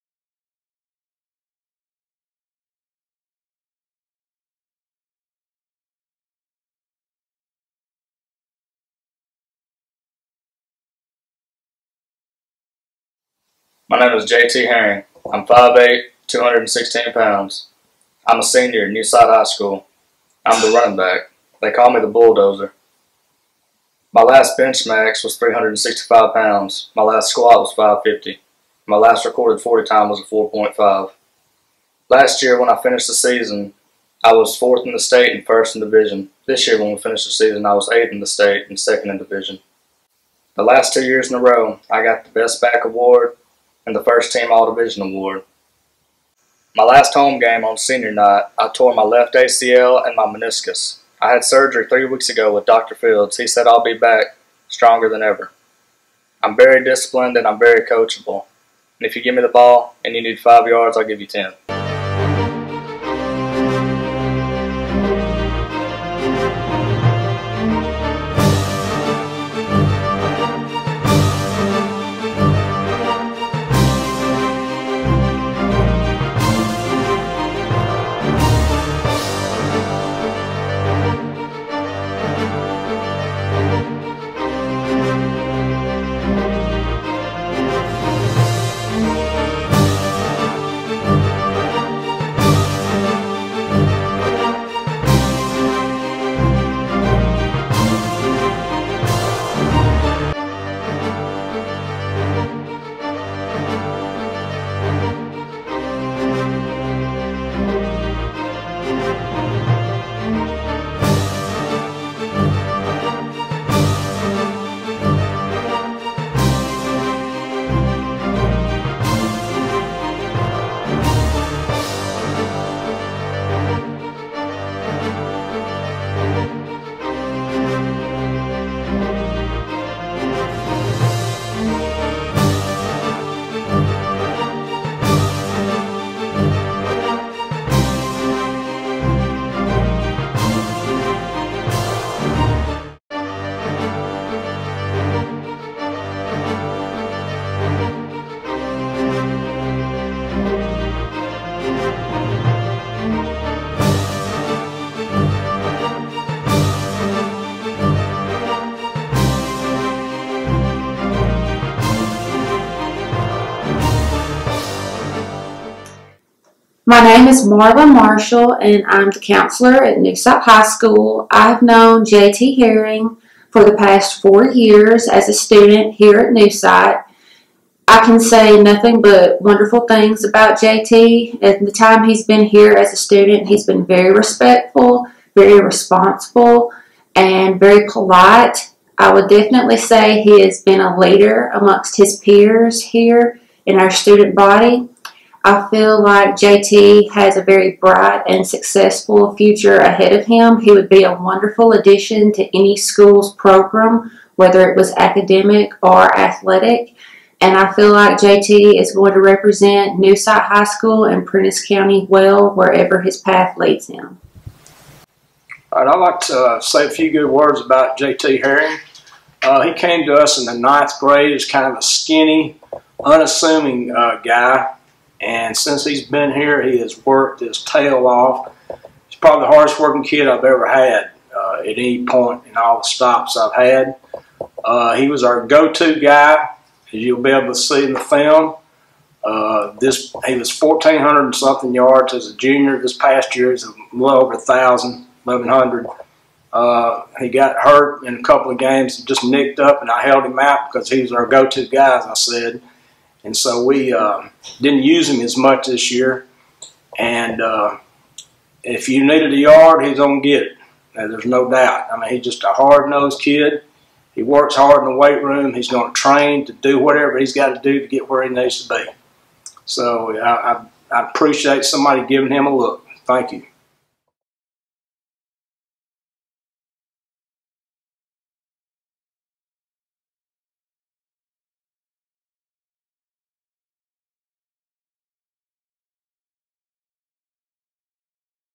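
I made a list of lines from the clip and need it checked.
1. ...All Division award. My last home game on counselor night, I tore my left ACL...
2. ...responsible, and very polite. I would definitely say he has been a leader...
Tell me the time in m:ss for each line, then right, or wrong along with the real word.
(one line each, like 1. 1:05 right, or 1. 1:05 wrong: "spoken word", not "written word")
1. 0:44 wrong: "senior", not "counselor"
2. 3:05 right.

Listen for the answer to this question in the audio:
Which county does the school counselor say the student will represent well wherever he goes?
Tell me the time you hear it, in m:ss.
3:31.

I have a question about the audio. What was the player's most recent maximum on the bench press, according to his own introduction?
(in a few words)
365 pounds.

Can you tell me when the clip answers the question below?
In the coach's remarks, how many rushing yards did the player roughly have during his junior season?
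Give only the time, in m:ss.
4:00.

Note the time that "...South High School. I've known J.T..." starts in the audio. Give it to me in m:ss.
2:50.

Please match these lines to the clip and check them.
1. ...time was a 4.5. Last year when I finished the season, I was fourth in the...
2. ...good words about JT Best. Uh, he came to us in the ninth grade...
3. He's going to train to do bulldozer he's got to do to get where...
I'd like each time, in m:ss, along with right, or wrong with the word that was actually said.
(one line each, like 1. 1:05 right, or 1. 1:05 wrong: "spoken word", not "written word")
1. 0:29 right
2. 3:37 wrong: "Herring", not "Best"
3. 4:25 wrong: "whatever", not "bulldozer".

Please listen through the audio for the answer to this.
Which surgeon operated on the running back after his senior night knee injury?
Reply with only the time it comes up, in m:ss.
0:52.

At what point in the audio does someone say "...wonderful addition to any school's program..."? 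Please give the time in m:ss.
3:21.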